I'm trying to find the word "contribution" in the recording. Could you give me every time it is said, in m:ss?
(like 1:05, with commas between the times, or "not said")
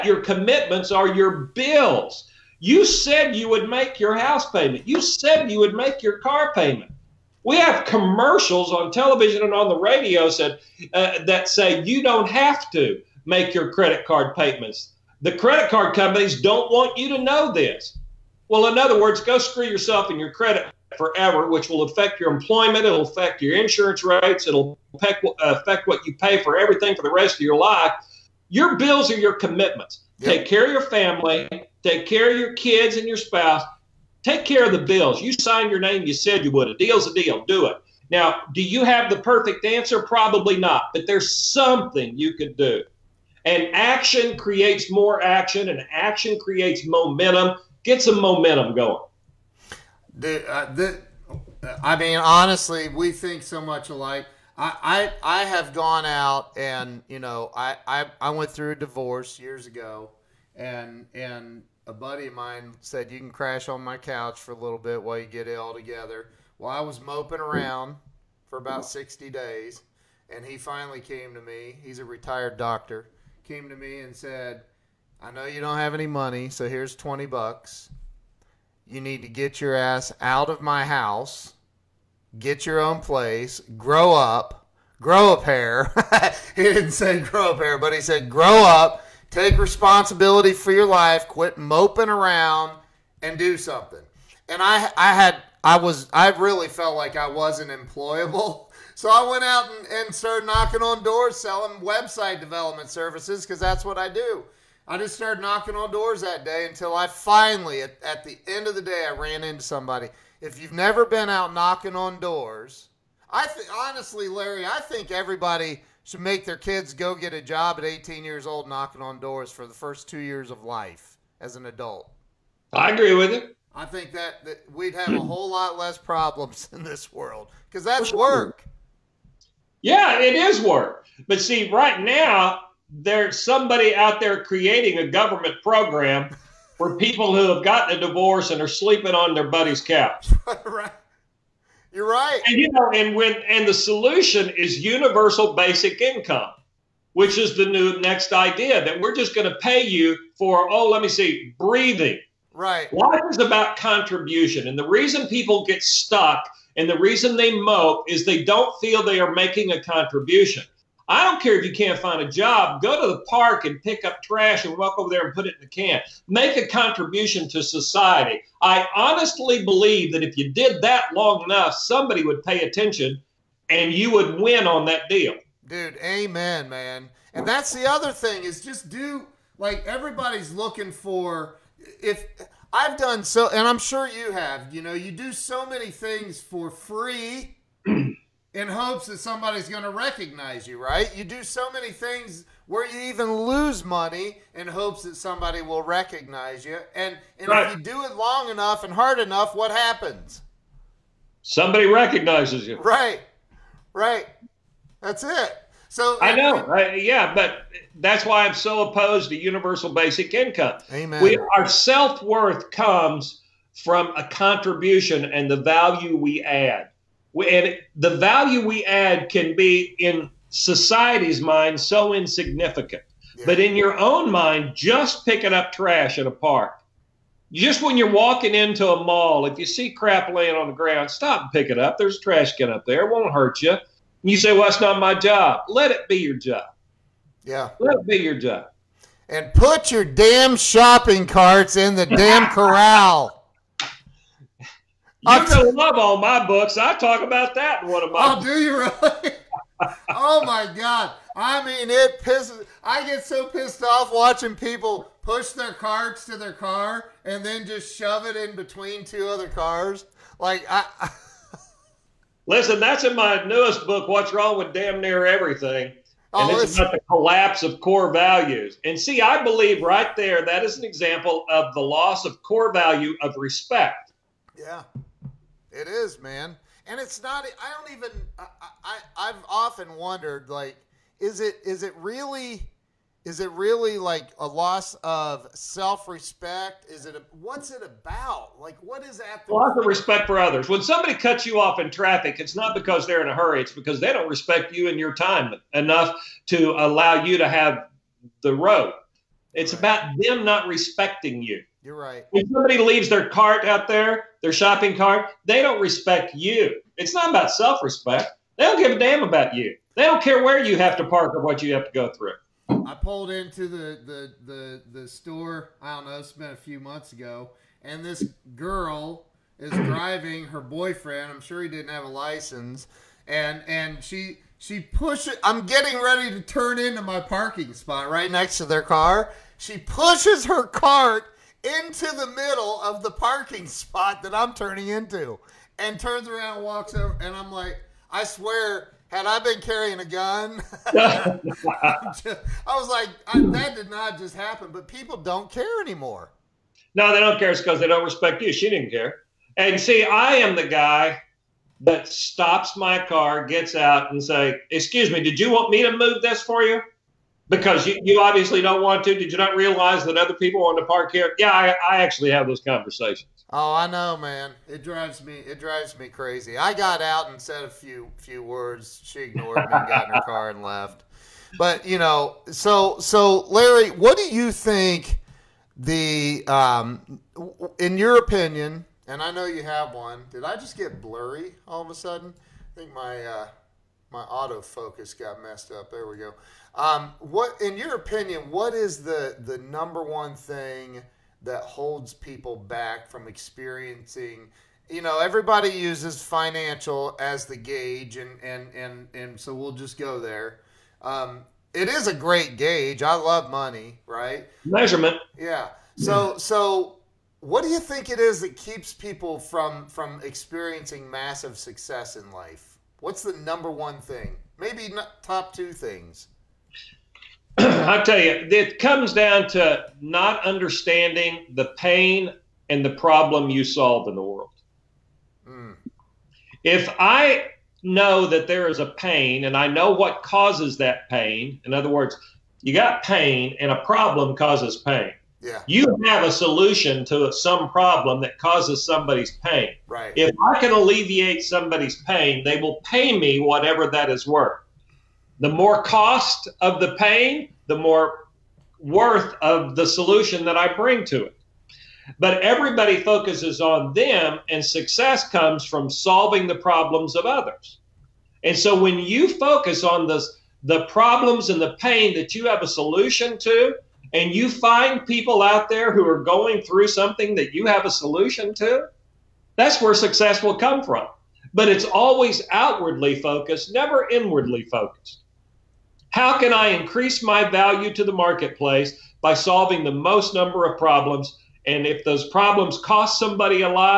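2:33, 2:39, 2:46, 3:34.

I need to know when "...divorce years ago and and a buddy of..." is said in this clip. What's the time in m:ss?
0:58.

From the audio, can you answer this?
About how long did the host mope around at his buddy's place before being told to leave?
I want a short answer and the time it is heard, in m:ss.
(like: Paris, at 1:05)
60 days, at 1:08.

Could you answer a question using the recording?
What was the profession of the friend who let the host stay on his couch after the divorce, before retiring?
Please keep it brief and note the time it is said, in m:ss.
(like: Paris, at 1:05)
Doctor, at 1:12.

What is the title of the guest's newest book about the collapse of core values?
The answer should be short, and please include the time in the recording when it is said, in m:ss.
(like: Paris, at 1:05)
What's Wrong with Damn Near Everything, at 4:24.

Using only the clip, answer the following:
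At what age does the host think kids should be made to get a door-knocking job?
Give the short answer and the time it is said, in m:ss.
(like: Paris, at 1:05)
18, at 1:57.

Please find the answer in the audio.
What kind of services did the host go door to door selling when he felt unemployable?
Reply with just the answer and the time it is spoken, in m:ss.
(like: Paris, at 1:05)
Website development, at 1:41.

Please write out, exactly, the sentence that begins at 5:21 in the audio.
I'm sure he didn't have a license.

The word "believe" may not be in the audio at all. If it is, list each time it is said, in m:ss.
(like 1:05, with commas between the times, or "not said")
2:49, 4:29.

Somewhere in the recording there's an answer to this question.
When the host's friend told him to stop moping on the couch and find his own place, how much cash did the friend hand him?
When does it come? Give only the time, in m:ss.
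1:16.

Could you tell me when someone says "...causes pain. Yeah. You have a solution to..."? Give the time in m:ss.
7:14.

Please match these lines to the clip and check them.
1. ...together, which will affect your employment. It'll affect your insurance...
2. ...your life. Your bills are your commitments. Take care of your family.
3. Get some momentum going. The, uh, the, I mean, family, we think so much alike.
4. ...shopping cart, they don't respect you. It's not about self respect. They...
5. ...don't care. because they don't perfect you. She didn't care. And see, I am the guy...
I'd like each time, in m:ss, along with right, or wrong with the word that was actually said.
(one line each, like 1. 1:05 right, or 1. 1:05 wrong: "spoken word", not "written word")
1. 0:20 wrong: "forever", not "together"
2. 0:27 right
3. 0:47 wrong: "honestly", not "family"
4. 5:04 right
5. 5:47 wrong: "respect", not "perfect".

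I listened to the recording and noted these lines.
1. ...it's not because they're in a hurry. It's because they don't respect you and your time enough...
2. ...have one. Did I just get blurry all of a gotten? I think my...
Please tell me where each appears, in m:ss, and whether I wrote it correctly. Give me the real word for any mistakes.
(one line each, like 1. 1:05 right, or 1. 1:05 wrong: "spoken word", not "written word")
1. 4:52 right
2. 6:19 wrong: "sudden", not "gotten".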